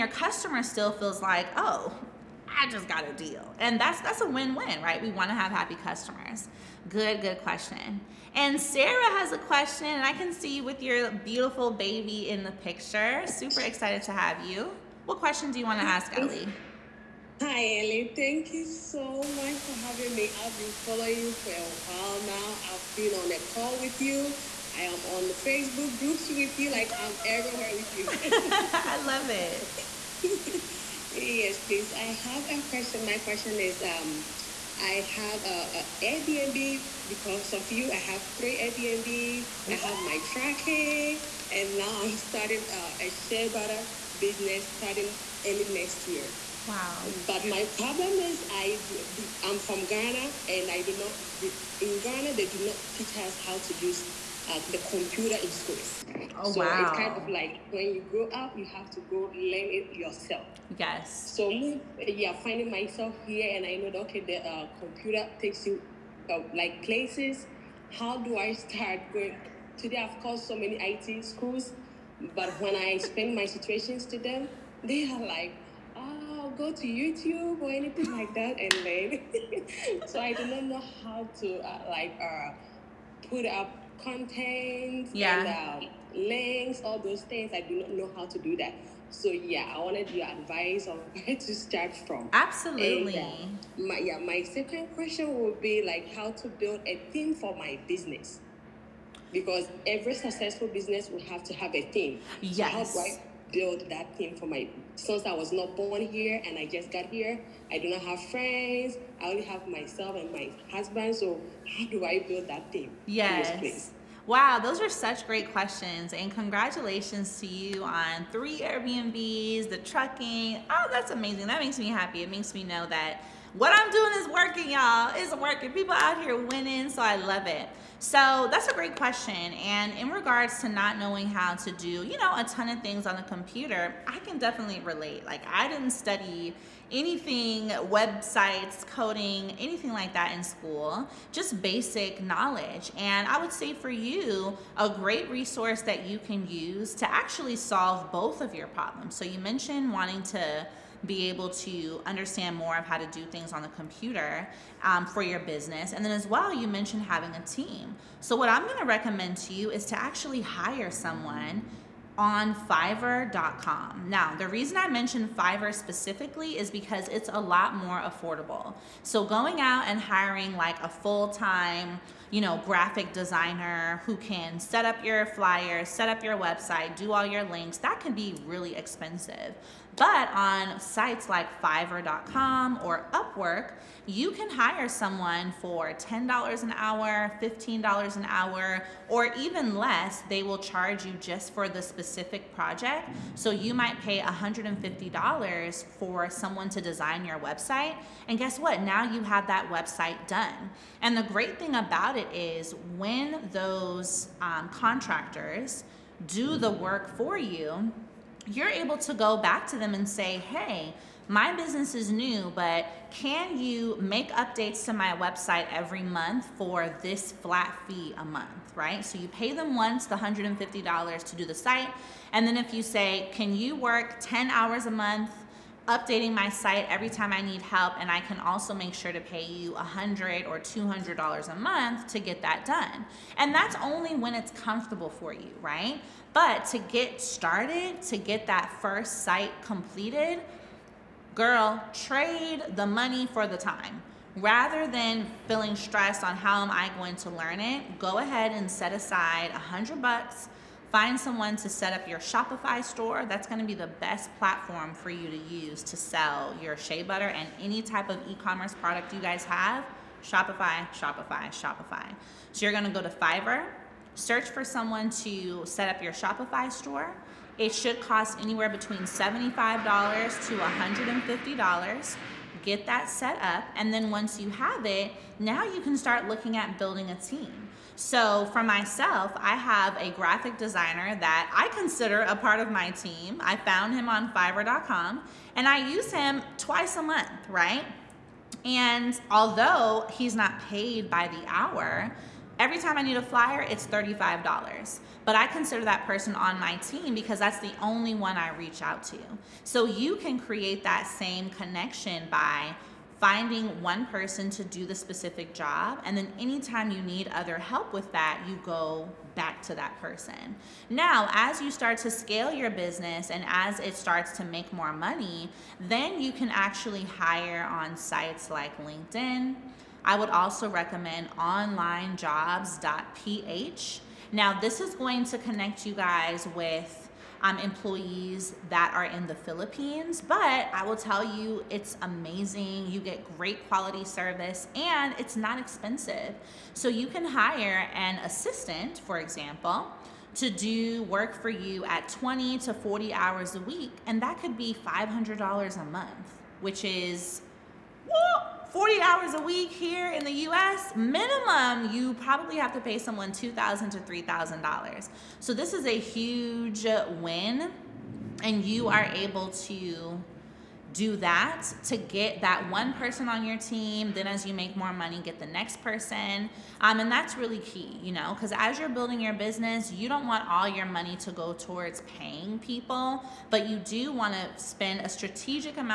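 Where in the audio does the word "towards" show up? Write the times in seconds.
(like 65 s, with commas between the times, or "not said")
371 s.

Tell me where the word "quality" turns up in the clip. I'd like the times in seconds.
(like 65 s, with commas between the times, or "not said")
333 s.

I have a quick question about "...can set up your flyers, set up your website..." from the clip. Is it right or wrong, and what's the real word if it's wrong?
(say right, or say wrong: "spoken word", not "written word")
right.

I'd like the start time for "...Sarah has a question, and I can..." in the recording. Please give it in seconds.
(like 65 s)
8 s.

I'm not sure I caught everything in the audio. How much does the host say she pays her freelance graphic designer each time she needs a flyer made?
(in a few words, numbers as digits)
$35.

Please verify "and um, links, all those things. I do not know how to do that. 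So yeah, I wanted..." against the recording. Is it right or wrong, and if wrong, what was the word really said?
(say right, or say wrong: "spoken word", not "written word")
right.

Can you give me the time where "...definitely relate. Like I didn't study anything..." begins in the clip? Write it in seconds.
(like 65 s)
134 s.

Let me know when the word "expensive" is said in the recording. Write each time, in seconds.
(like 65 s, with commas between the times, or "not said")
178 s, 335 s.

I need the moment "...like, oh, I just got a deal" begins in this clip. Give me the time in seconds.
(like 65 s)
1 s.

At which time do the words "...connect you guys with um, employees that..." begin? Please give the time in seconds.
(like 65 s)
325 s.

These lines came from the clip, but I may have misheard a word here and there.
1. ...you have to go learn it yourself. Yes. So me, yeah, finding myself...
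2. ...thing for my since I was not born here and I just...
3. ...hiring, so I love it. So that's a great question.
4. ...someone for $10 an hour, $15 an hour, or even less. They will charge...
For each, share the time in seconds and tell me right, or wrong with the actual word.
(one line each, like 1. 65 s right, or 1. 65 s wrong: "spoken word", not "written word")
1. 58 s right
2. 104 s right
3. 126 s wrong: "winning", not "hiring"
4. 184 s right.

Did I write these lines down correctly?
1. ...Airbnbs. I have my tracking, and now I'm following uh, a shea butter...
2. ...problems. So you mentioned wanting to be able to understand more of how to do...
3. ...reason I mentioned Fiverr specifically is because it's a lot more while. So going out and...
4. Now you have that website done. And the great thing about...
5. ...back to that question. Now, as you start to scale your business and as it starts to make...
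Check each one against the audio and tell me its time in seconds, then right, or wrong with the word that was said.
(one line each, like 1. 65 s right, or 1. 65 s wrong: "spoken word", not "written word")
1. 38 s wrong: "starting", not "following"
2. 148 s right
3. 164 s wrong: "affordable", not "while"
4. 198 s right
5. 309 s wrong: "person", not "question".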